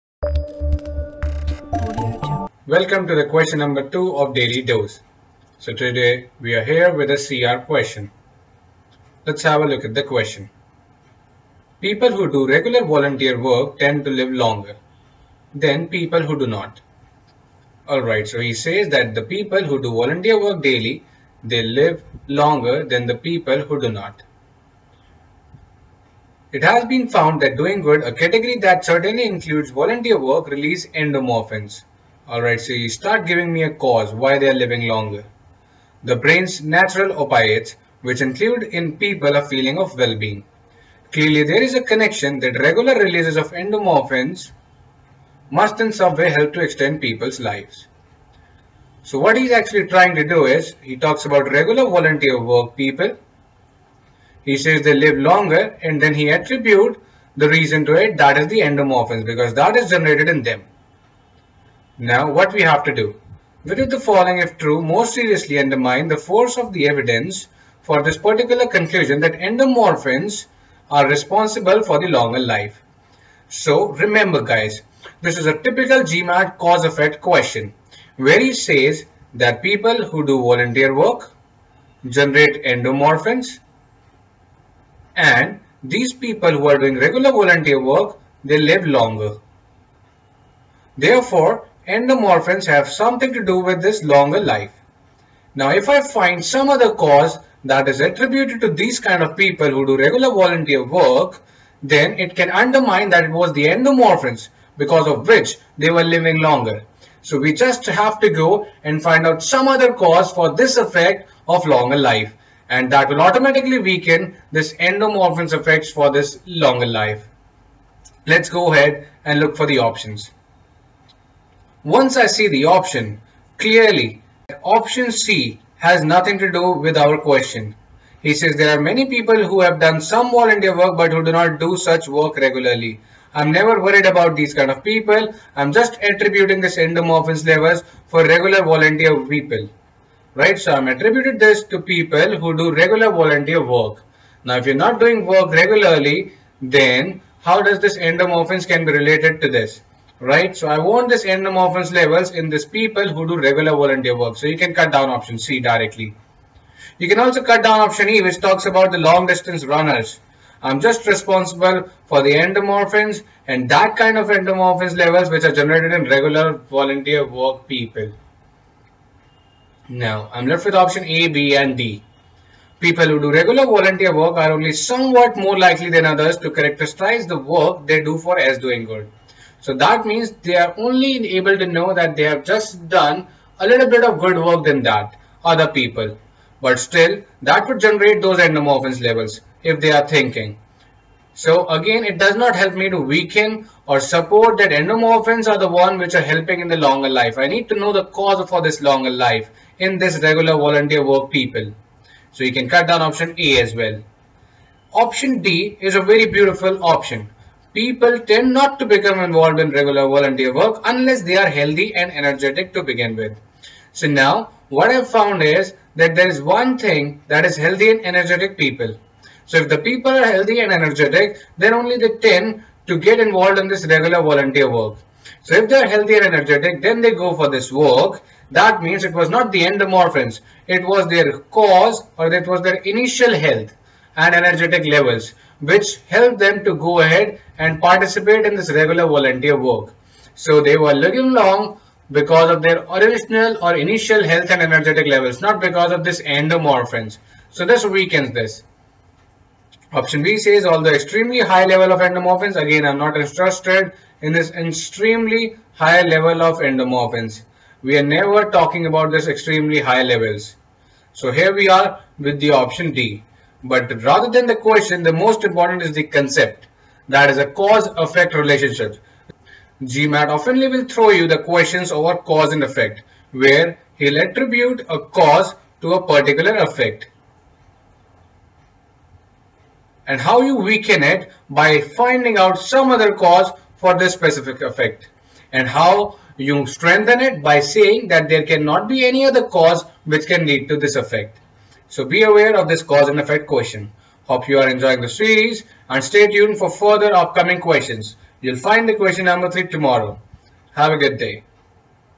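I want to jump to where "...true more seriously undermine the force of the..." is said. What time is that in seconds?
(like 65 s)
64 s.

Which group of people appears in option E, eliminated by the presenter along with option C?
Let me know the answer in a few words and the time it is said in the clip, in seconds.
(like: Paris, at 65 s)
long distance runners, at 158 s.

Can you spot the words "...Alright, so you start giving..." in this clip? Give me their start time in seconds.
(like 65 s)
32 s.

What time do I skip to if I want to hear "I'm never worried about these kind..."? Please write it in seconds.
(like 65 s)
133 s.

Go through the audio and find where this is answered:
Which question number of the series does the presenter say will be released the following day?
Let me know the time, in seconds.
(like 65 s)
298 s.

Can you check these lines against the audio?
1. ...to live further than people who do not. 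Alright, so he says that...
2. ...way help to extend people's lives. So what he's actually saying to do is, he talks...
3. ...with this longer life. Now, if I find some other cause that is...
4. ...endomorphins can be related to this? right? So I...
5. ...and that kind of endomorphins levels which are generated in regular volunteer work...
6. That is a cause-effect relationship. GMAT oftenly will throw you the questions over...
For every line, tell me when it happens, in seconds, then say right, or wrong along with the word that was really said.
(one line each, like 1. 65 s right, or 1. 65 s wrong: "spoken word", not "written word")
1. 14 s wrong: "longer", not "further"
2. 46 s wrong: "trying", not "saying"
3. 93 s right
4. 147 s right
5. 163 s right
6. 267 s right.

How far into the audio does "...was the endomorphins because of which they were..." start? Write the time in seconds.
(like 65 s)
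103 s.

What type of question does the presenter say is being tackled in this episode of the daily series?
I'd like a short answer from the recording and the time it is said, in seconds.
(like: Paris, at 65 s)
CR question, at 7 s.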